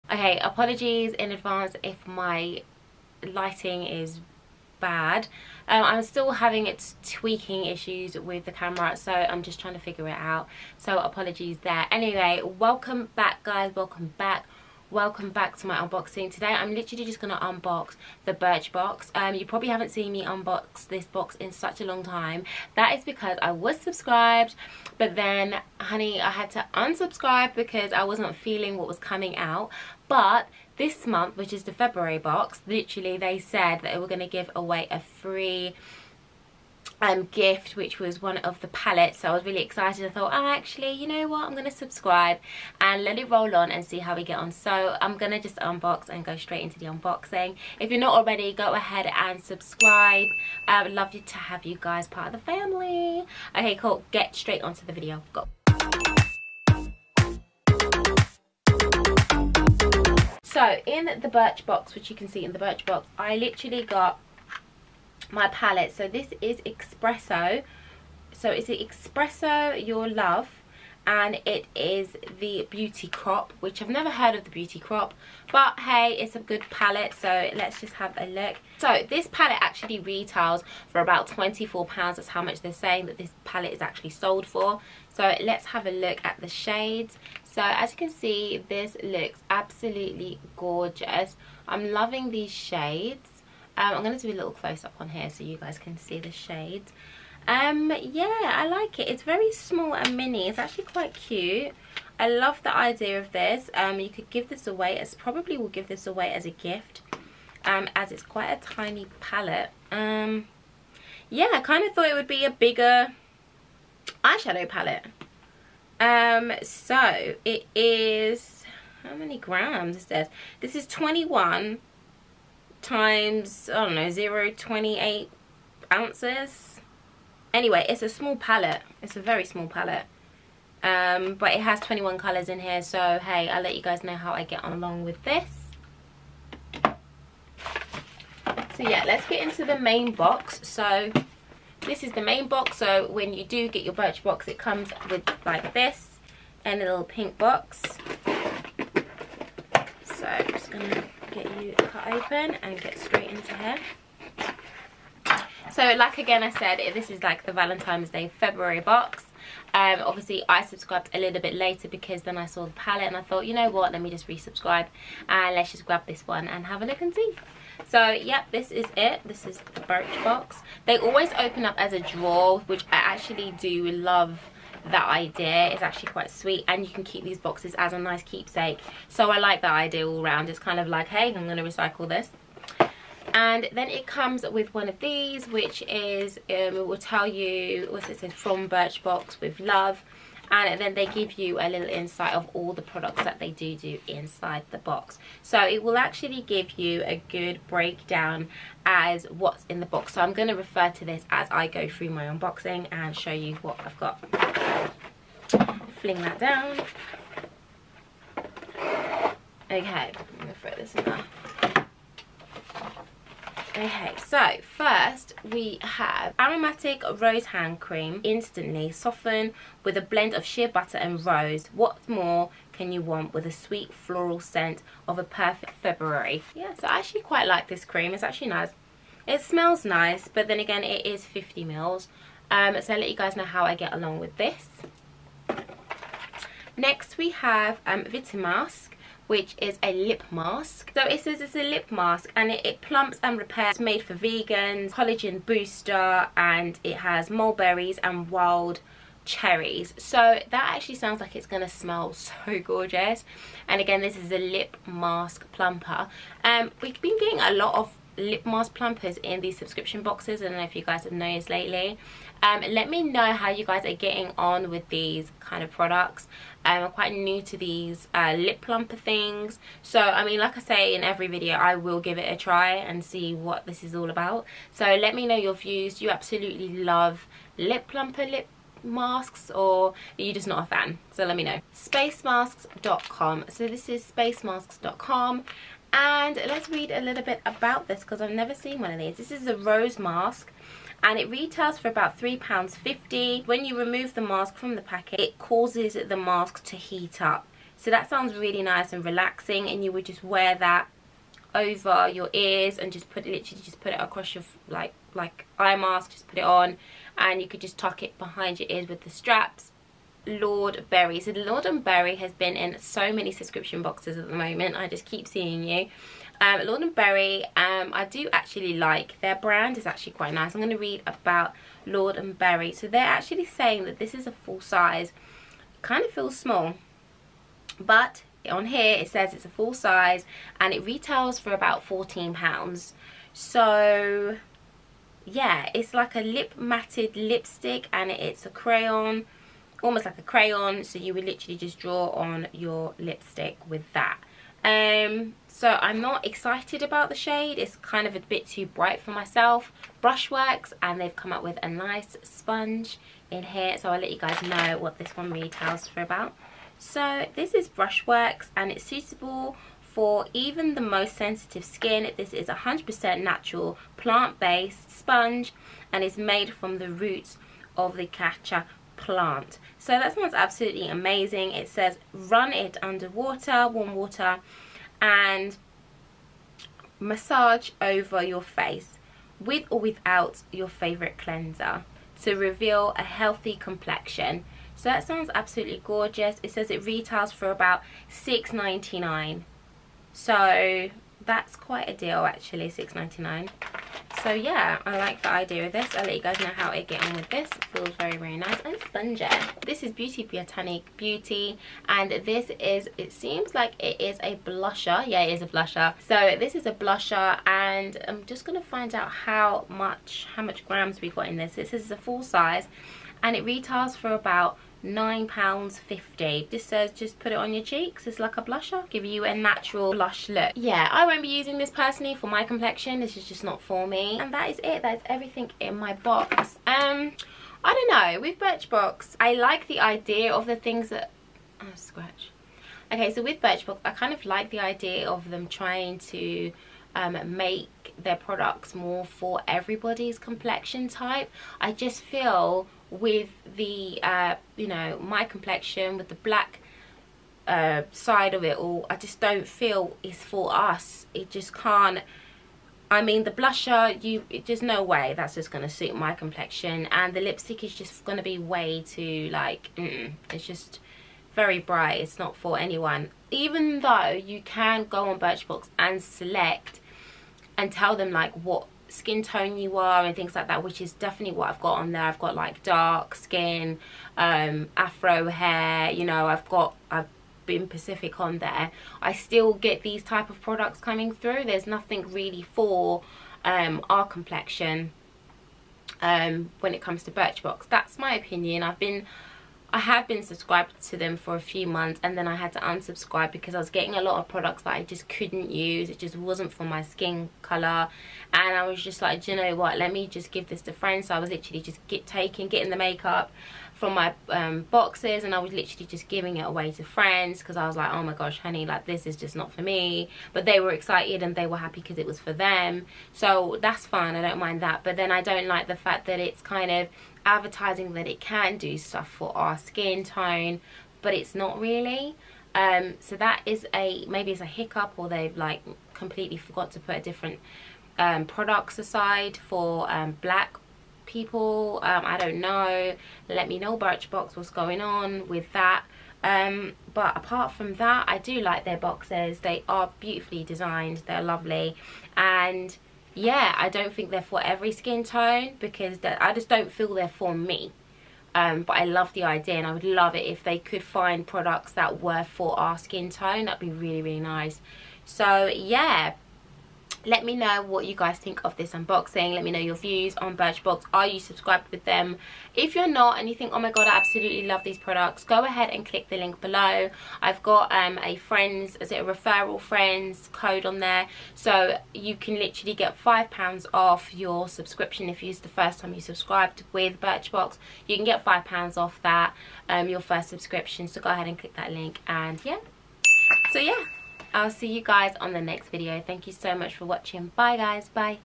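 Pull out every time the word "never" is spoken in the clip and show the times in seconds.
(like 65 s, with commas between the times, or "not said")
73 s, 288 s.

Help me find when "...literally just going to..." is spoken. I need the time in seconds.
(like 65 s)
16 s.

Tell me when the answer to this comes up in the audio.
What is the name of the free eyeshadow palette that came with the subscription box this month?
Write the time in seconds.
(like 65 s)
68 s.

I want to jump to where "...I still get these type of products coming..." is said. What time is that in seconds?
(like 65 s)
479 s.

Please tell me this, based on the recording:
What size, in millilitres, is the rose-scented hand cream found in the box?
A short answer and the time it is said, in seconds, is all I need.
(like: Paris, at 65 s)
50 ml, at 231 s.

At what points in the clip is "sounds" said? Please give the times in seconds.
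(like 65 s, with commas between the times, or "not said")
250 s, 298 s, 370 s, 385 s.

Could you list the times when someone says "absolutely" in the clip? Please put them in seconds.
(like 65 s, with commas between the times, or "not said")
89 s, 276 s, 370 s, 385 s, 563 s.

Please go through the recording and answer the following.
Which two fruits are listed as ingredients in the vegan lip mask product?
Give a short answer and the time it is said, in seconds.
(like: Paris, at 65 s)
Mulberries and wild cherries, at 247 s.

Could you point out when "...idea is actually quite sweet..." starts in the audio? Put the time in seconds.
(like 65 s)
175 s.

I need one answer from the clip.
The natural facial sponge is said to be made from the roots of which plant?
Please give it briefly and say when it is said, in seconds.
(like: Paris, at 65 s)
Catcha plant, at 368 s.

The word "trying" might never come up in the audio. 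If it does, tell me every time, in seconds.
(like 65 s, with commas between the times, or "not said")
9 s, 435 s.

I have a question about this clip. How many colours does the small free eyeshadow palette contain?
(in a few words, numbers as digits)
21.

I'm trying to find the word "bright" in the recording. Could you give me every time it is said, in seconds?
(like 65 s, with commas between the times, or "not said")
348 s, 461 s.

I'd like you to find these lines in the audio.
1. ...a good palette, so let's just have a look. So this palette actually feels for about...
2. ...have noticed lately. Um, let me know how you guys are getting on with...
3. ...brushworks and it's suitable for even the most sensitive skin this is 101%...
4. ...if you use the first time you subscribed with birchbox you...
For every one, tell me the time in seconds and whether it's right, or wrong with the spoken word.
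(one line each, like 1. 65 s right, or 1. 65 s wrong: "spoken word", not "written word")
1. 76 s wrong: "retails", not "feels"
2. 261 s right
3. 357 s wrong: "100", not "101"
4. 575 s right.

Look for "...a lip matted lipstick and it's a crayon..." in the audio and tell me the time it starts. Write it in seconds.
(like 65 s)
336 s.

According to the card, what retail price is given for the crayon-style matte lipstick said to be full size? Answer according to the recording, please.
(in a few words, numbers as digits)
14 pounds.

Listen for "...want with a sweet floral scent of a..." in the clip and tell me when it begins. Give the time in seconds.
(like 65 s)
223 s.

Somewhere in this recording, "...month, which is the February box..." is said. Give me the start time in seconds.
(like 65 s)
31 s.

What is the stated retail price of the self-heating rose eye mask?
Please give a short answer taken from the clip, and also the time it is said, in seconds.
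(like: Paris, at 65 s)
£3.50, at 292 s.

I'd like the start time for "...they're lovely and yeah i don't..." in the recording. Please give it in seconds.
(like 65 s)
541 s.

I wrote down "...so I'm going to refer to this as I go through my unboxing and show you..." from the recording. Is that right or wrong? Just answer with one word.
right.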